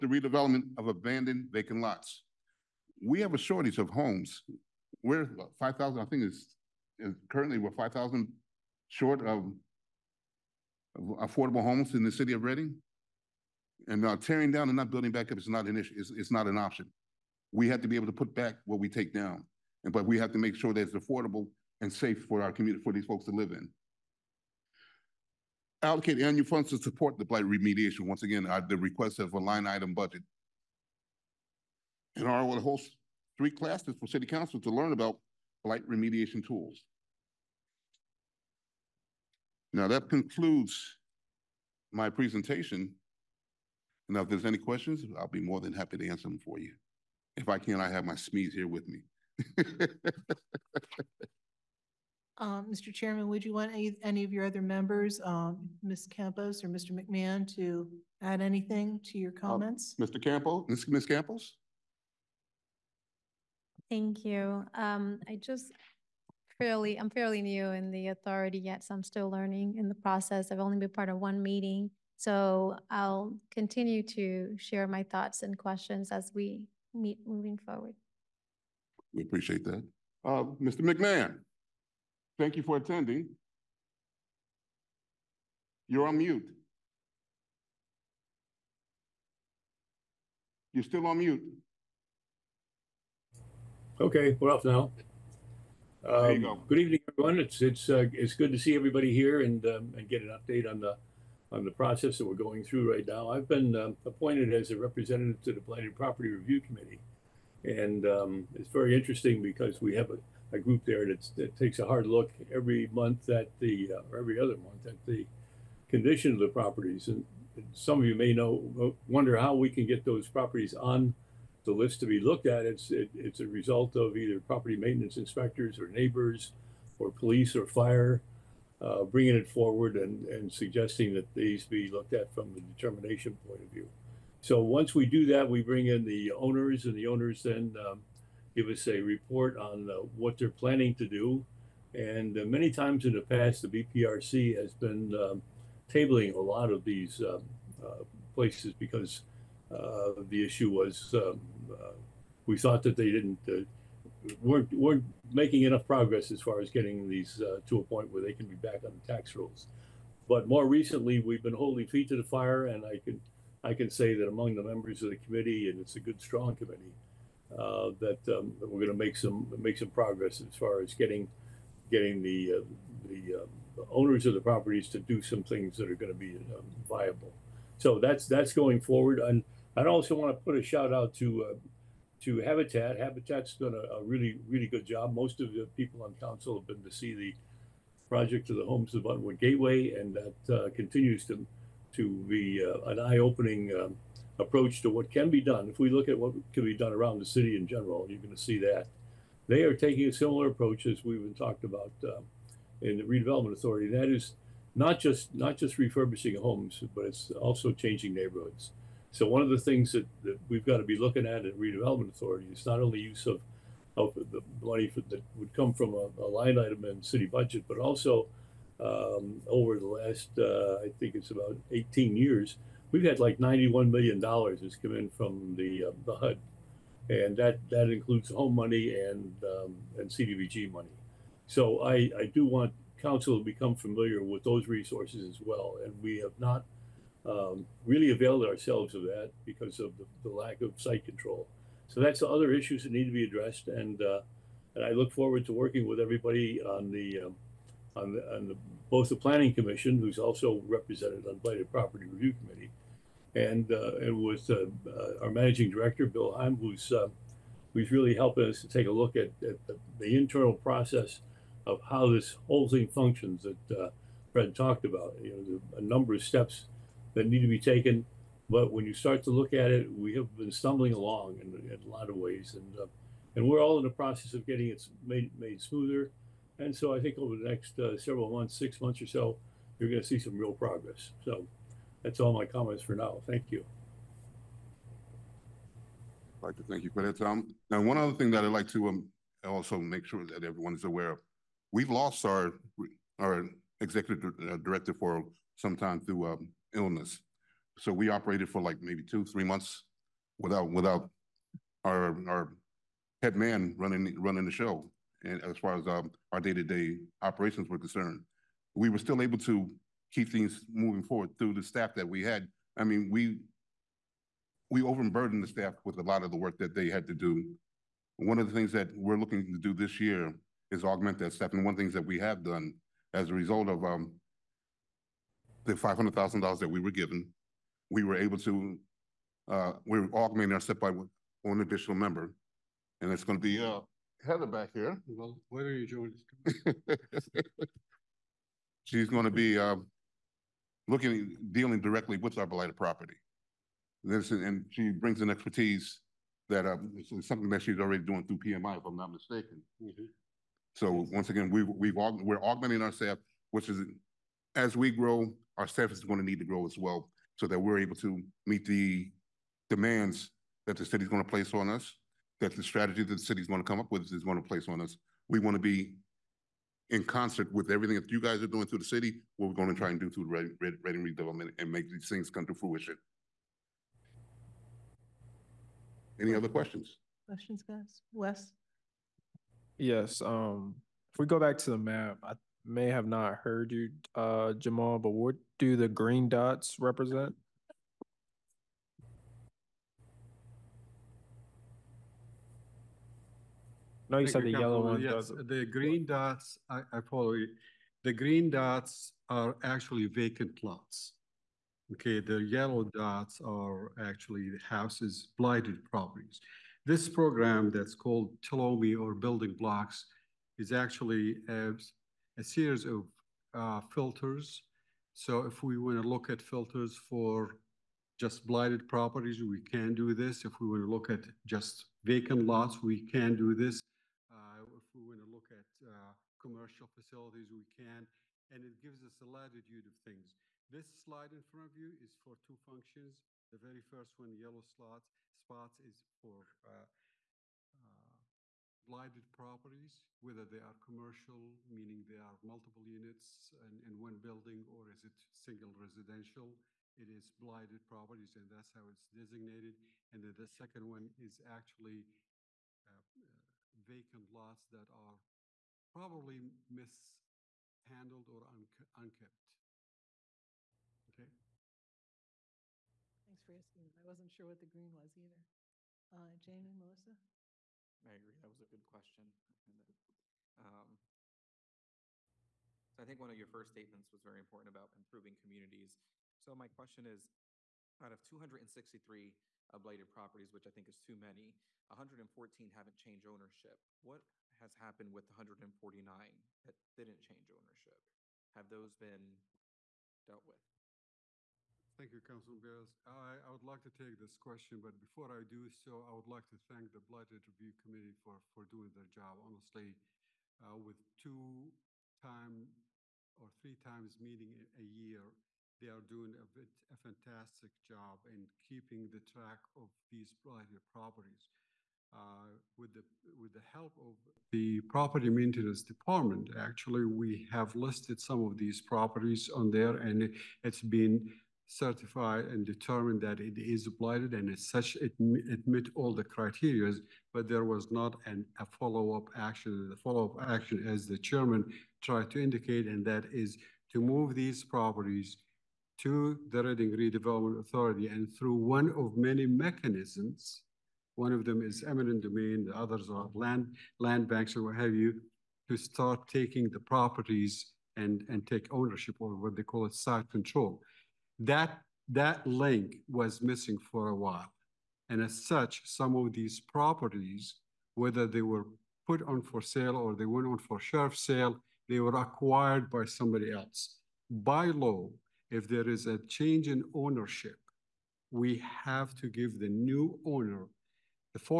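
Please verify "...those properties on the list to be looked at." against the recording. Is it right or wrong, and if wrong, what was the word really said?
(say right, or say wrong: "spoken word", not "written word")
right.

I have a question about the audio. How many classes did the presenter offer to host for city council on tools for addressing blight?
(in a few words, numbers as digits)
3.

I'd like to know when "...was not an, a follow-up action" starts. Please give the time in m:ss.
8:47.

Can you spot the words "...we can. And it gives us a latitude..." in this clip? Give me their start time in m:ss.
7:07.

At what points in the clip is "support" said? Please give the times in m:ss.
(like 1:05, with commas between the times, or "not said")
0:26.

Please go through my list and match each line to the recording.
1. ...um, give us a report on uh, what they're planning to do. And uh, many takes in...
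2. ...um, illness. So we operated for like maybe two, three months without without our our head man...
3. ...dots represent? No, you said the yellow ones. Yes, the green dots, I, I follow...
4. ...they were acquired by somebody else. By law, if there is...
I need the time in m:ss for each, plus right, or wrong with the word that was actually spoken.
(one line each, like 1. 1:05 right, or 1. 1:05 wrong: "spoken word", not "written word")
1. 2:17 wrong: "times", not "takes"
2. 4:56 right
3. 6:26 right
4. 9:21 right.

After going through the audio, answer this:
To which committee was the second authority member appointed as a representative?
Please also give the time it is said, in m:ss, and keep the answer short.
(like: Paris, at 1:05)
Planning Property Review Committee, at 1:45.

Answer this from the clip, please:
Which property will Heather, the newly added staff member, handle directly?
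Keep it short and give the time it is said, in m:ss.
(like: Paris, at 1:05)
Arboleda, at 5:42.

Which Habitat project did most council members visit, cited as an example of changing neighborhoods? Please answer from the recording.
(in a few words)
Homes of Buttonwood Gateway.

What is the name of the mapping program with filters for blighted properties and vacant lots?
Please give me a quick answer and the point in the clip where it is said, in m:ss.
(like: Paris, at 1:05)
Tolemi, at 6:48.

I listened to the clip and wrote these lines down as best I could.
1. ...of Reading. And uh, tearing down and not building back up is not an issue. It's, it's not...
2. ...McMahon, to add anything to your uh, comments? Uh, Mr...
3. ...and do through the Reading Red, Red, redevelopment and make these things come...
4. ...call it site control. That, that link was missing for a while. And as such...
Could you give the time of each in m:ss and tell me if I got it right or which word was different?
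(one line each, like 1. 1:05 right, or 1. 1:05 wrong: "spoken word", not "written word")
1. 0:12 right
2. 0:56 right
3. 6:09 right
4. 9:09 right.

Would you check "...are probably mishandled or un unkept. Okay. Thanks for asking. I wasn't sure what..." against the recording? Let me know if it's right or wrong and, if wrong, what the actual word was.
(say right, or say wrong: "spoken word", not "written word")
right.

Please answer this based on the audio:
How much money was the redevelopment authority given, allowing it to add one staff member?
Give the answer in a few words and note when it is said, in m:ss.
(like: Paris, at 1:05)
$500,000, at 5:25.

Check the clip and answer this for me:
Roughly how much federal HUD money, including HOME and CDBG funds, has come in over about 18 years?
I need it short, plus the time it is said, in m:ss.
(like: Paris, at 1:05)
$91 million, at 3:43.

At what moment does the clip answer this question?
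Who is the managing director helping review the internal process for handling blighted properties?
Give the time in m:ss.
4:16.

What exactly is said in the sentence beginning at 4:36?
And so I think over the next uh, several months, six months or so, you're going to see some real progress.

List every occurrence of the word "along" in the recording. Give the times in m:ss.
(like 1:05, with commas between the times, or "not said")
4:30.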